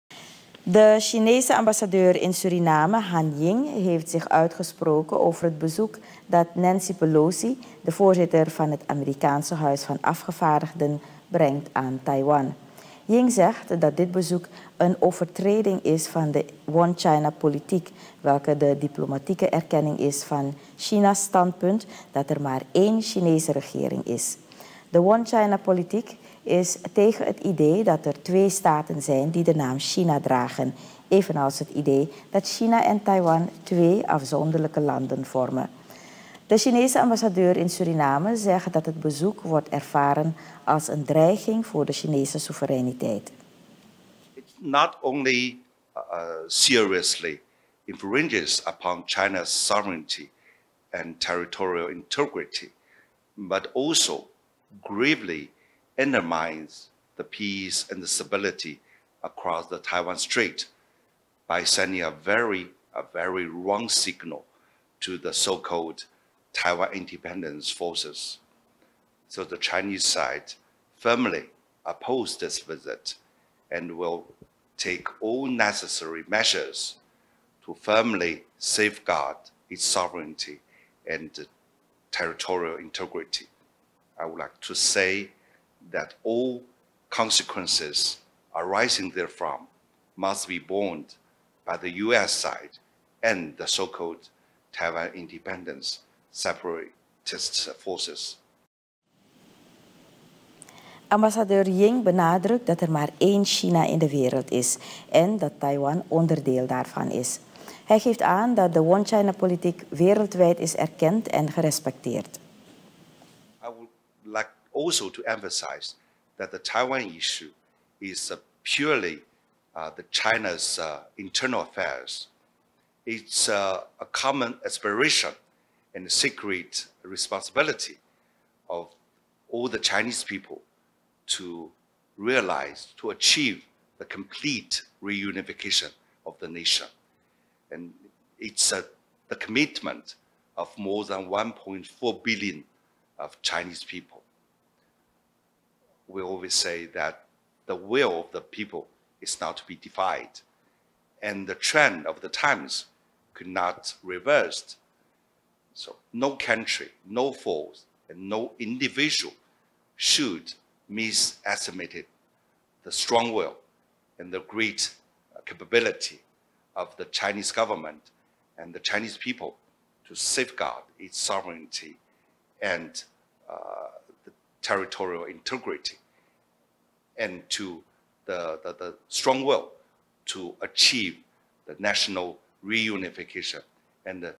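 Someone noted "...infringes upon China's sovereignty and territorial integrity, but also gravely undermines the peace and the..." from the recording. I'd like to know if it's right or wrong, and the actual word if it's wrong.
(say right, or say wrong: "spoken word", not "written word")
right.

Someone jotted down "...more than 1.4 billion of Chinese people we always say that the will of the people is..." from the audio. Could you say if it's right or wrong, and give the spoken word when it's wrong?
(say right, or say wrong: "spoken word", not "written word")
right.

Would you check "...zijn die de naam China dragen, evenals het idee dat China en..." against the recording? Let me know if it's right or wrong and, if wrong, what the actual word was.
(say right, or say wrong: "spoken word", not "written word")
right.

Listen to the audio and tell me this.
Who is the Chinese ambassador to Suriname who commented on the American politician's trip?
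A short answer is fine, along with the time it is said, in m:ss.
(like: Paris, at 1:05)
Han Ying, at 0:02.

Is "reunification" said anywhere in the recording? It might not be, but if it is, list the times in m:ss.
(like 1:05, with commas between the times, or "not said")
2:15, 3:02.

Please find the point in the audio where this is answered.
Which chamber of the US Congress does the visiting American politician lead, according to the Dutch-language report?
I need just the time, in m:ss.
0:09.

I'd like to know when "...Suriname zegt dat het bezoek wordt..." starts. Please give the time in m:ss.
0:37.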